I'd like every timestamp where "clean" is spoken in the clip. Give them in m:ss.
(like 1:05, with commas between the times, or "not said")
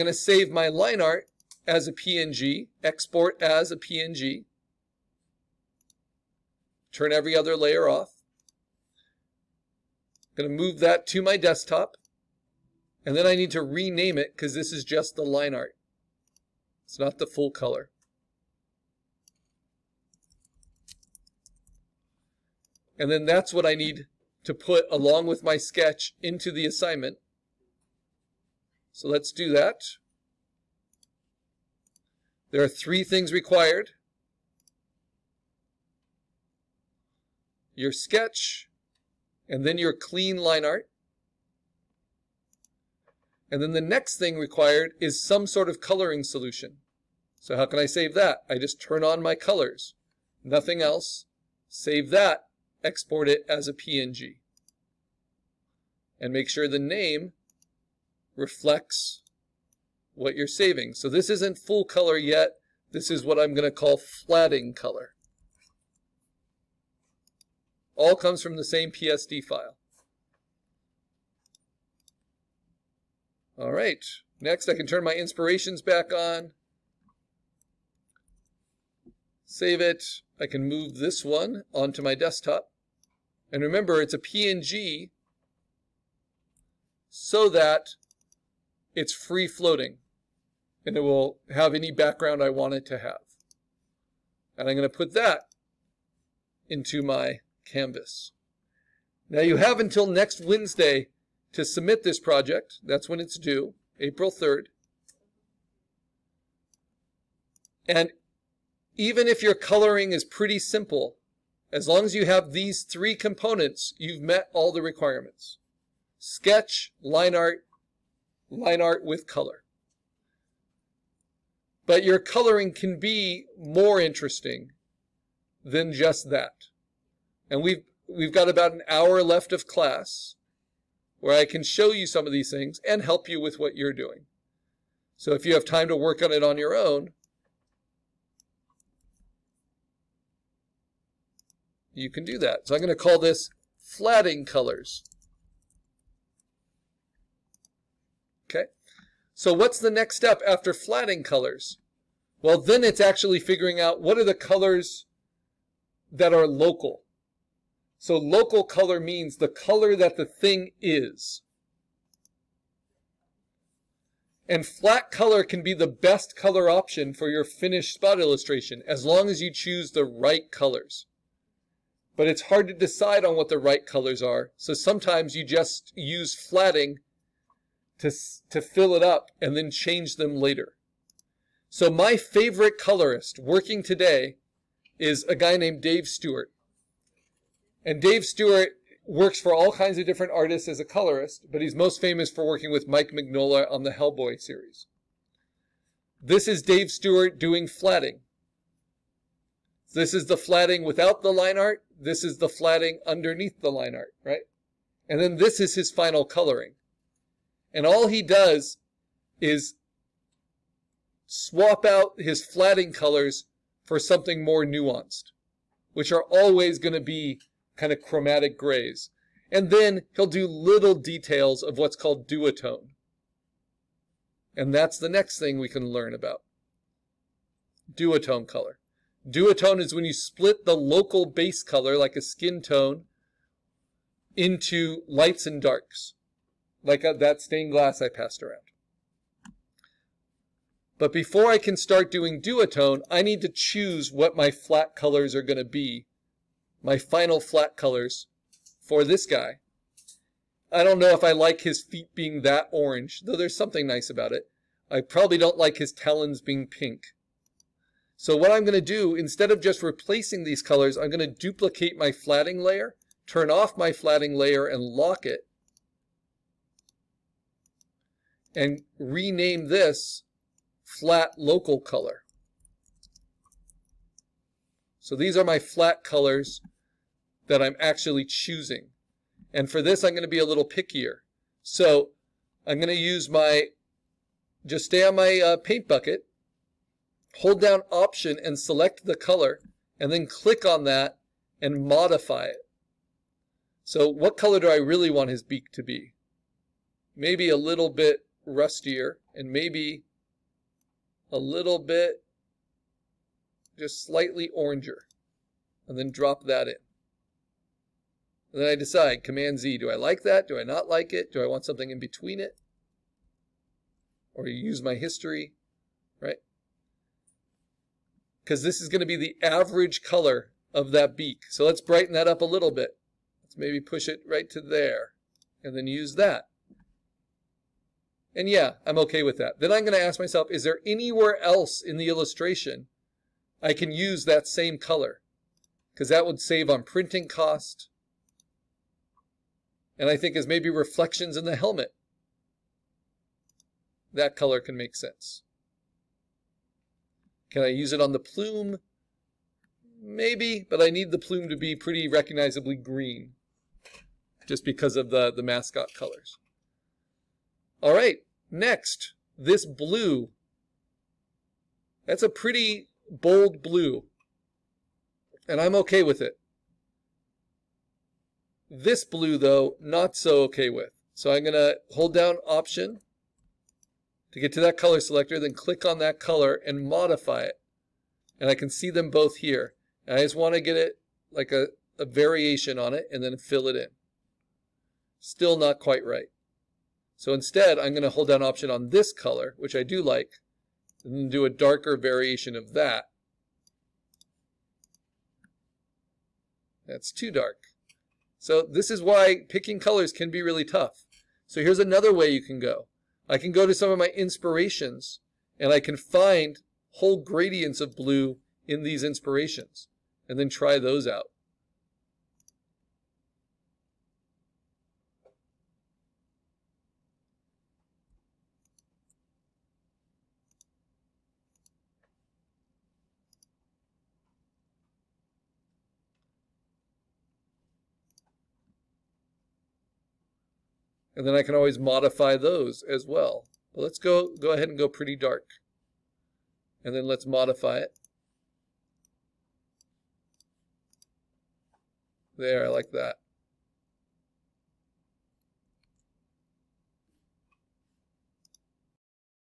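0:39.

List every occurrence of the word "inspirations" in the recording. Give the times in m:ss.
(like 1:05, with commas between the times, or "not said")
1:15, 6:44, 6:49.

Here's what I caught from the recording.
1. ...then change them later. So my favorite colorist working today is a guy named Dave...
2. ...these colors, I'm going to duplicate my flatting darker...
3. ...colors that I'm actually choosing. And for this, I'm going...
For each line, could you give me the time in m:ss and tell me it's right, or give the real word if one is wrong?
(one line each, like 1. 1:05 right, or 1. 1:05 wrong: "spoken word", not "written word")
1. 2:59 right
2. 4:20 wrong: "layer", not "darker"
3. 4:36 right.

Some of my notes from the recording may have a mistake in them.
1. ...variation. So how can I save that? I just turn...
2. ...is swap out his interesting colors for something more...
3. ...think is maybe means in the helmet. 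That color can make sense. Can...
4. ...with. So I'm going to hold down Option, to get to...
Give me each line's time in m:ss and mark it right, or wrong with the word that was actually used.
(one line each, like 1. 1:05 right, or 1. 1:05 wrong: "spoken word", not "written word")
1. 0:46 wrong: "solution", not "variation"
2. 3:29 wrong: "flatting", not "interesting"
3. 5:40 wrong: "reflections", not "means"
4. 6:10 right.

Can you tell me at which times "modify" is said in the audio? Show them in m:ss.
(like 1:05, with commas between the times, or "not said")
4:51, 6:16, 7:11, 7:17.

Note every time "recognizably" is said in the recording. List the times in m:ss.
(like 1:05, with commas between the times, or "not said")
5:52.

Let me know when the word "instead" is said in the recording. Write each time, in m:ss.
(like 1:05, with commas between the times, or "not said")
4:19, 6:27.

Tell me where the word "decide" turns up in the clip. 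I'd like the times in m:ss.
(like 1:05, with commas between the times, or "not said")
2:52, 5:08.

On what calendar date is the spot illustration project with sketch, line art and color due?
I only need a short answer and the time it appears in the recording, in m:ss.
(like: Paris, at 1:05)
April 3rd, at 1:43.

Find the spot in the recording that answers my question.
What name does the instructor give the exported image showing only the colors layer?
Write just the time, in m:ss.
1:03.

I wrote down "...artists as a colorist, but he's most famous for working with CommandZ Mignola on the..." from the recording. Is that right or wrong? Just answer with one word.
wrong.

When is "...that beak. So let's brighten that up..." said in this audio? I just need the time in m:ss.
5:20.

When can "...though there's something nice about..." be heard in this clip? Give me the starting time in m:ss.
4:13.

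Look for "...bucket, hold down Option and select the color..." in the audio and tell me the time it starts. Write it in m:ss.
4:45.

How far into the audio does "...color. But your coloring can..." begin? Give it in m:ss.
1:59.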